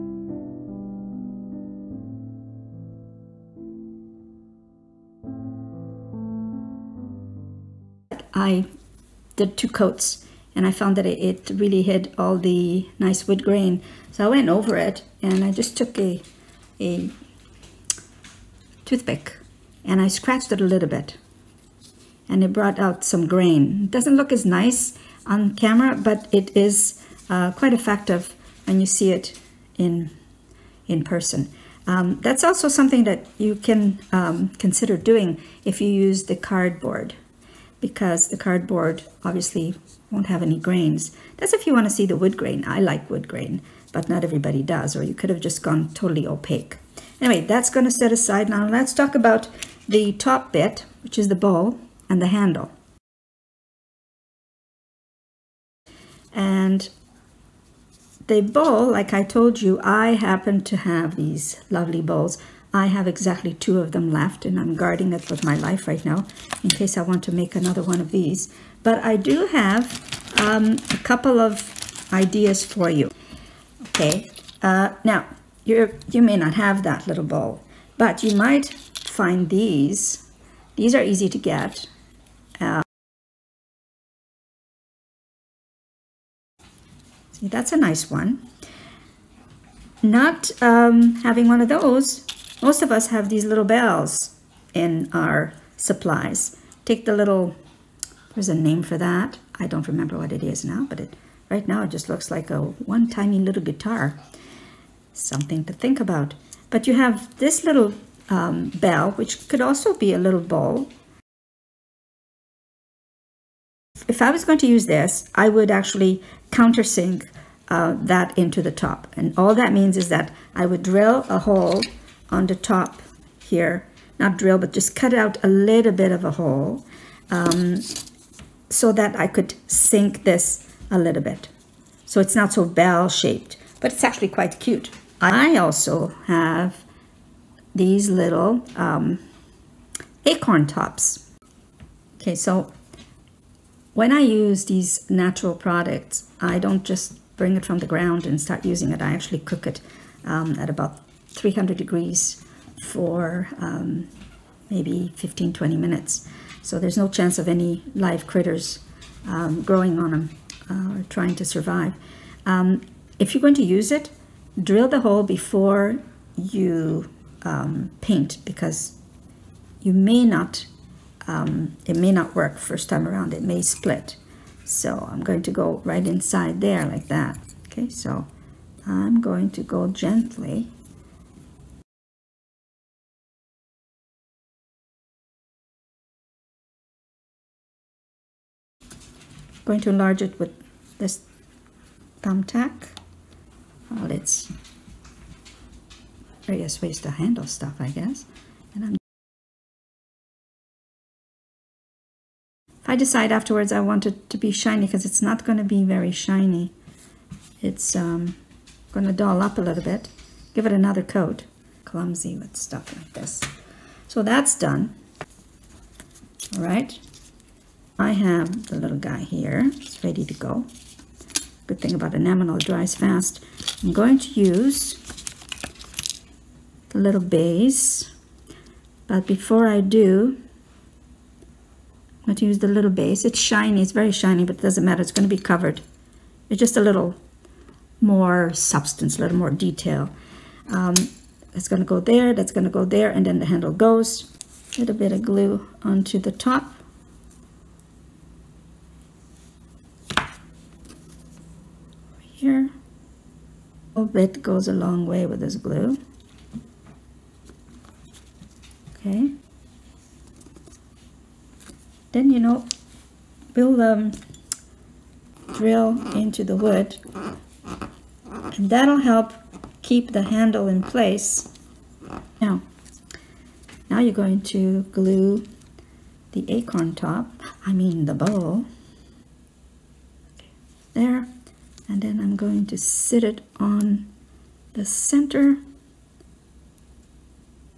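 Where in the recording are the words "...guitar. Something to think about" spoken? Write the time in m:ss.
1:43.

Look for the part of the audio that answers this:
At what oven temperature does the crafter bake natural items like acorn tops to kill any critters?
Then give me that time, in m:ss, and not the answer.
2:31.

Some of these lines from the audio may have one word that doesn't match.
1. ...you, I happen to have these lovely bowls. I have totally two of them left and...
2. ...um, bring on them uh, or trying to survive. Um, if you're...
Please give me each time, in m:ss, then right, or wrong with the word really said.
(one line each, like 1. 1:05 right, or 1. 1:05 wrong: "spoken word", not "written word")
1. 0:59 wrong: "exactly", not "totally"
2. 2:39 wrong: "growing", not "bring".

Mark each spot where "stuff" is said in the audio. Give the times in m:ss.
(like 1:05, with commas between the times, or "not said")
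3:17, 3:32.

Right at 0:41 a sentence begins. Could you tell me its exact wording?
That's if you want to see the wood grain.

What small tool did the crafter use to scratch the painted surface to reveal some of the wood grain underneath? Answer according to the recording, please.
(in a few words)
Toothpick.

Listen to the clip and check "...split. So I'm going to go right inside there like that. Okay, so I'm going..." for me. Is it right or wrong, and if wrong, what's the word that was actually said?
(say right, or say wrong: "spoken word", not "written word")
right.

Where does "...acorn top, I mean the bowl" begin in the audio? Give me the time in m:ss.
4:36.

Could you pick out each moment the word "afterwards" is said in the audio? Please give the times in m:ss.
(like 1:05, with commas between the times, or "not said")
3:23.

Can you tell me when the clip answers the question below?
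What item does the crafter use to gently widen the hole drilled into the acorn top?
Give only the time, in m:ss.
3:12.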